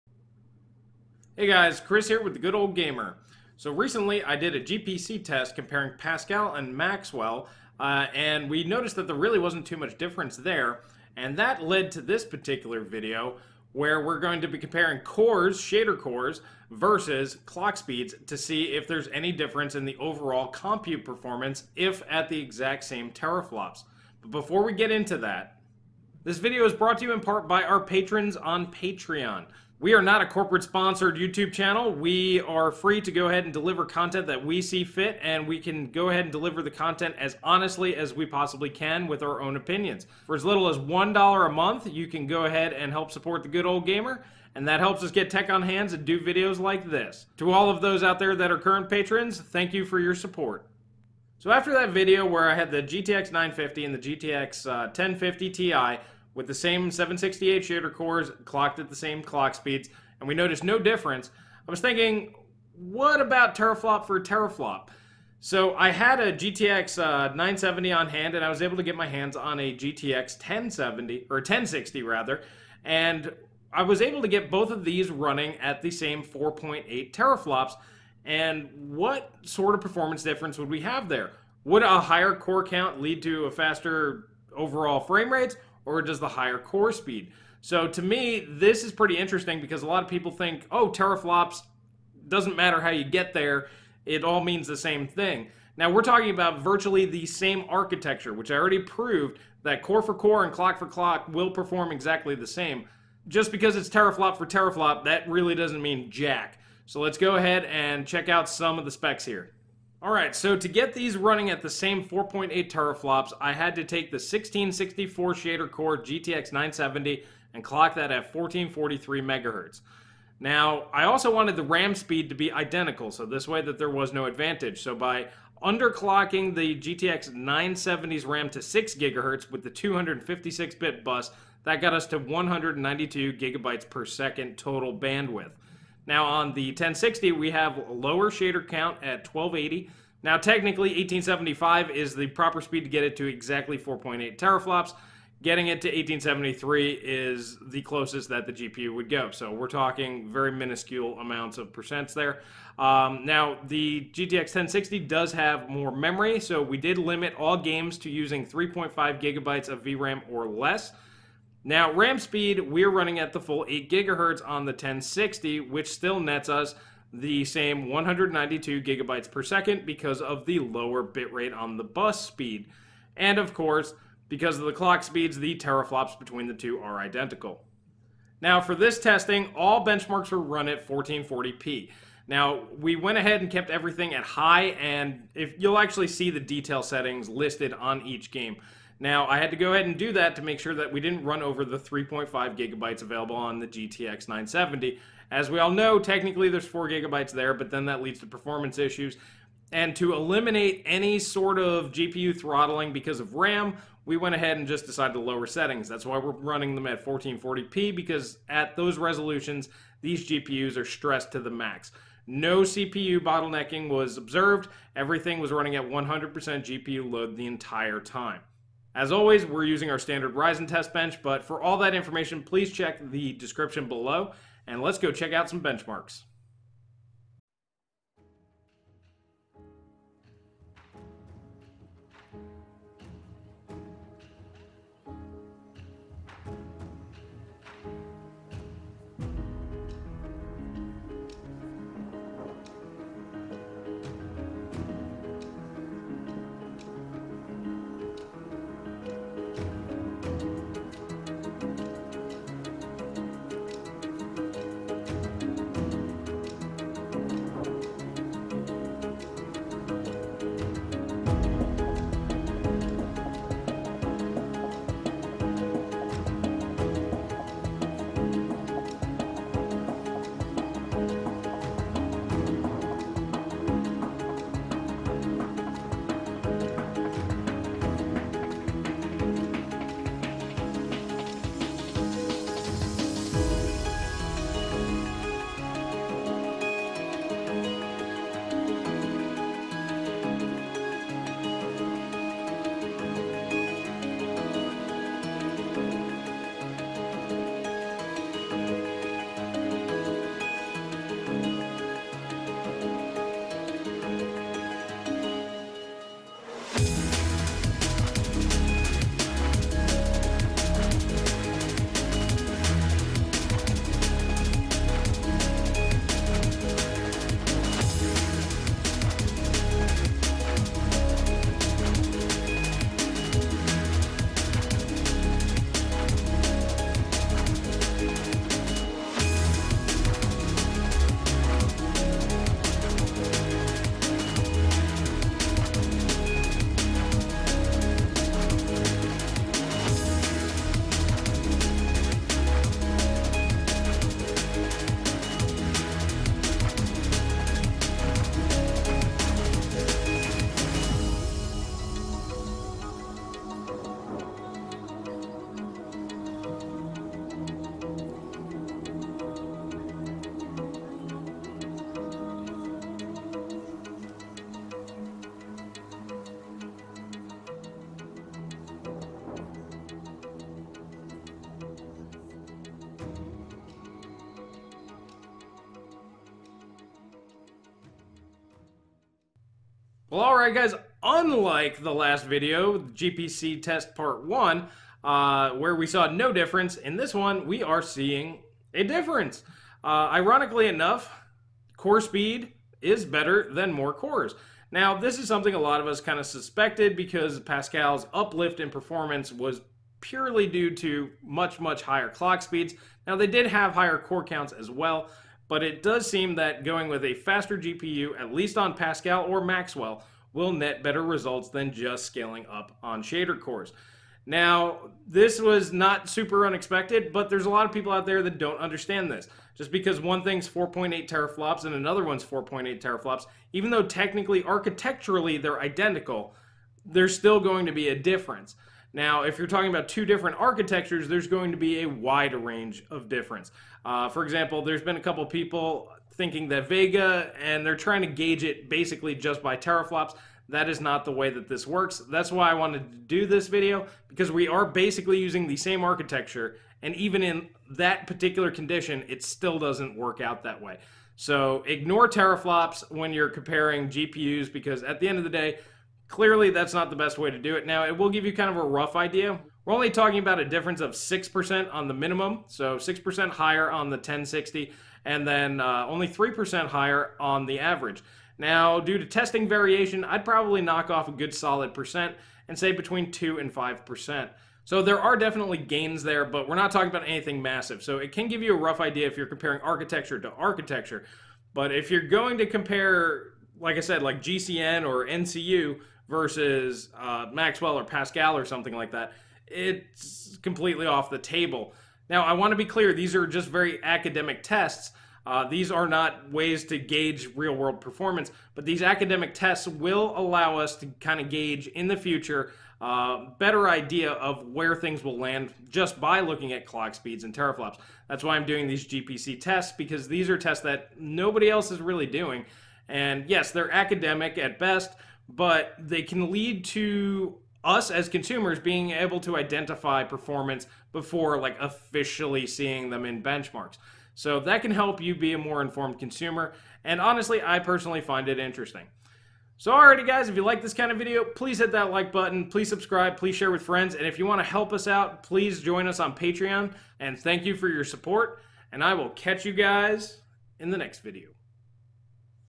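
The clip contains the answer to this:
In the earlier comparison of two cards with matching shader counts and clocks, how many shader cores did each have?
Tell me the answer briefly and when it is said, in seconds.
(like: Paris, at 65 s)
768, at 56 s.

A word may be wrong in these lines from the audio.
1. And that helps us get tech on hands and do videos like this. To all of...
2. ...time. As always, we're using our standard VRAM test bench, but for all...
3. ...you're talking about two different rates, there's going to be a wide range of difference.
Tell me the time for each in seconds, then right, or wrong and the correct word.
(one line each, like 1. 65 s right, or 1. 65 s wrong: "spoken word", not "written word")
1. 44 s right
2. 217 s wrong: "Ryzen", not "VRAM"
3. 429 s wrong: "architectures", not "rates".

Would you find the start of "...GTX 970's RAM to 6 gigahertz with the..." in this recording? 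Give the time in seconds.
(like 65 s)
126 s.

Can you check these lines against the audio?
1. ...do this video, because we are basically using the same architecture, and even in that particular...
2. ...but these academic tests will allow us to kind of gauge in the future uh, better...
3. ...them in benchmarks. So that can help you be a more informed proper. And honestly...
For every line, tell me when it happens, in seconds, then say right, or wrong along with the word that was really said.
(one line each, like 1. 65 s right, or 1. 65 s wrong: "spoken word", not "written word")
1. 442 s right
2. 498 s right
3. 522 s wrong: "consumer", not "proper".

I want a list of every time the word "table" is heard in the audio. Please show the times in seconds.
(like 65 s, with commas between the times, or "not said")
491 s.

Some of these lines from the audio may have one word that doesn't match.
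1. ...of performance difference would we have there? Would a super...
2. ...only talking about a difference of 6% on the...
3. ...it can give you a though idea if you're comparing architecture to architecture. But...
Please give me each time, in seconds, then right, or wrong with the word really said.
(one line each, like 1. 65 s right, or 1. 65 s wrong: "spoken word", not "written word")
1. 79 s wrong: "higher", not "super"
2. 459 s right
3. 477 s wrong: "rough", not "though".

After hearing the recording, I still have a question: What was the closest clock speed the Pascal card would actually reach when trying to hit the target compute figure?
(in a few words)
1873.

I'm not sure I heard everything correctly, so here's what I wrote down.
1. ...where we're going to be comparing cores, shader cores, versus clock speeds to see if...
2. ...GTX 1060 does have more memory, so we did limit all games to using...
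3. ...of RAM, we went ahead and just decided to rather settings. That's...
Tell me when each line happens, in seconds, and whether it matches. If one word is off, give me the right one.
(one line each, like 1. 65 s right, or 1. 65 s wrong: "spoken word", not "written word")
1. 13 s right
2. 154 s right
3. 203 s wrong: "lower", not "rather".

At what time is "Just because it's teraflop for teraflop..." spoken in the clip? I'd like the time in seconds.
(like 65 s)
103 s.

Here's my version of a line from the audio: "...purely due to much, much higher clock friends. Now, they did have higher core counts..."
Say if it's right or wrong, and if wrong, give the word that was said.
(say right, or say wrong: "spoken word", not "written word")
wrong: "speeds", not "friends".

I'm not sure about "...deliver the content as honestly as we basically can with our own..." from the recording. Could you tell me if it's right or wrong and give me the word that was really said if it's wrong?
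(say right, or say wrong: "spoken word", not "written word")
wrong: "possibly", not "basically".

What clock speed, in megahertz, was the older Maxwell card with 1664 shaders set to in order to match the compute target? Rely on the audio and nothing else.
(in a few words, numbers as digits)
1443.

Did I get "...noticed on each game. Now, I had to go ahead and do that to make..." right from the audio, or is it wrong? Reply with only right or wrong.
wrong.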